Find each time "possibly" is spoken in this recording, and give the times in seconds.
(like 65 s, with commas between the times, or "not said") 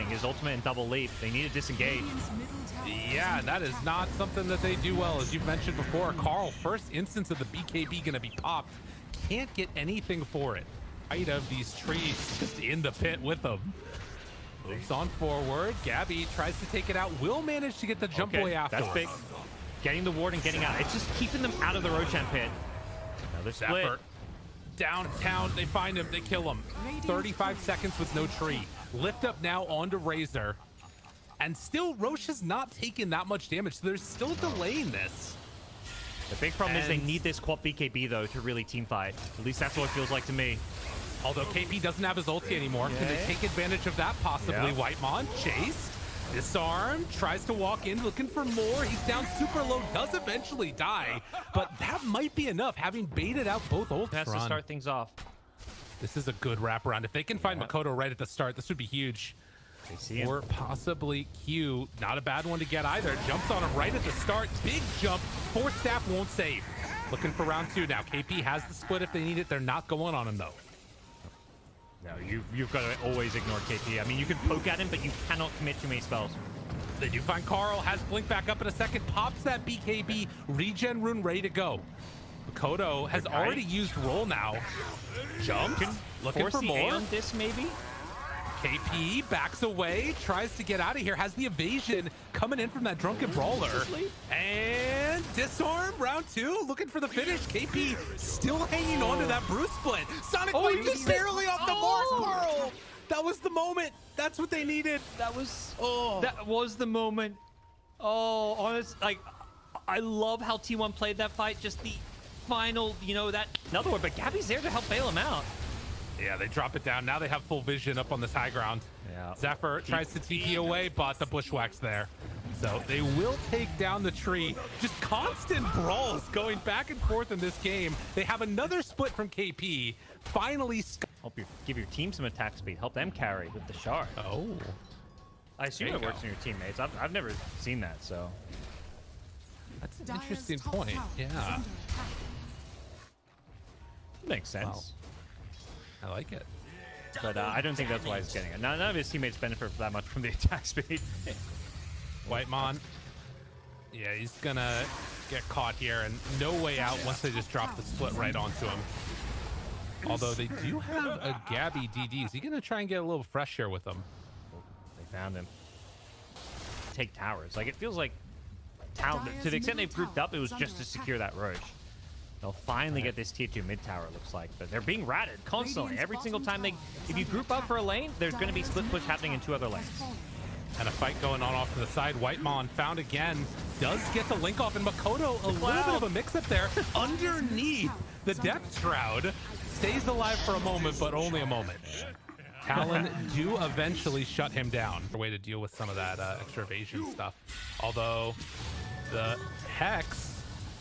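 44 s, 60 s.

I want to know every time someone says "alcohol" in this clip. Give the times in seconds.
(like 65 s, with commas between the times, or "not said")
not said.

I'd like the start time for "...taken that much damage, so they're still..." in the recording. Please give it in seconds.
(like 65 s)
32 s.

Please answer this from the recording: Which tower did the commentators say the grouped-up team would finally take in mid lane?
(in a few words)
Tier 2 mid tower.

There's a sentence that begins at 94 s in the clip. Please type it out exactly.
And disarm round two, looking for the finish.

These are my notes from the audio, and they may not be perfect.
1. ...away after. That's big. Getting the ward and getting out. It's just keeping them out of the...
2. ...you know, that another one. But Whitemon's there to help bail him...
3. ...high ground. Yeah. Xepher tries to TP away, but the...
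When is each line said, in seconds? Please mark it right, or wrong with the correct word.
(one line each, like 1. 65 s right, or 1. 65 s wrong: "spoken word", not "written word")
1. 18 s right
2. 113 s wrong: "Gabbi", not "Whitemon"
3. 118 s right.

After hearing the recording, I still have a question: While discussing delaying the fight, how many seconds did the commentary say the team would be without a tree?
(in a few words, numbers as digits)
35.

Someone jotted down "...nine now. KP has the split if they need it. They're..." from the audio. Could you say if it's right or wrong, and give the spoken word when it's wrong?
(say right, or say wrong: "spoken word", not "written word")
wrong: "two", not "nine".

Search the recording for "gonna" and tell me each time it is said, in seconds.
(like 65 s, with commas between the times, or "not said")
154 s, 162 s.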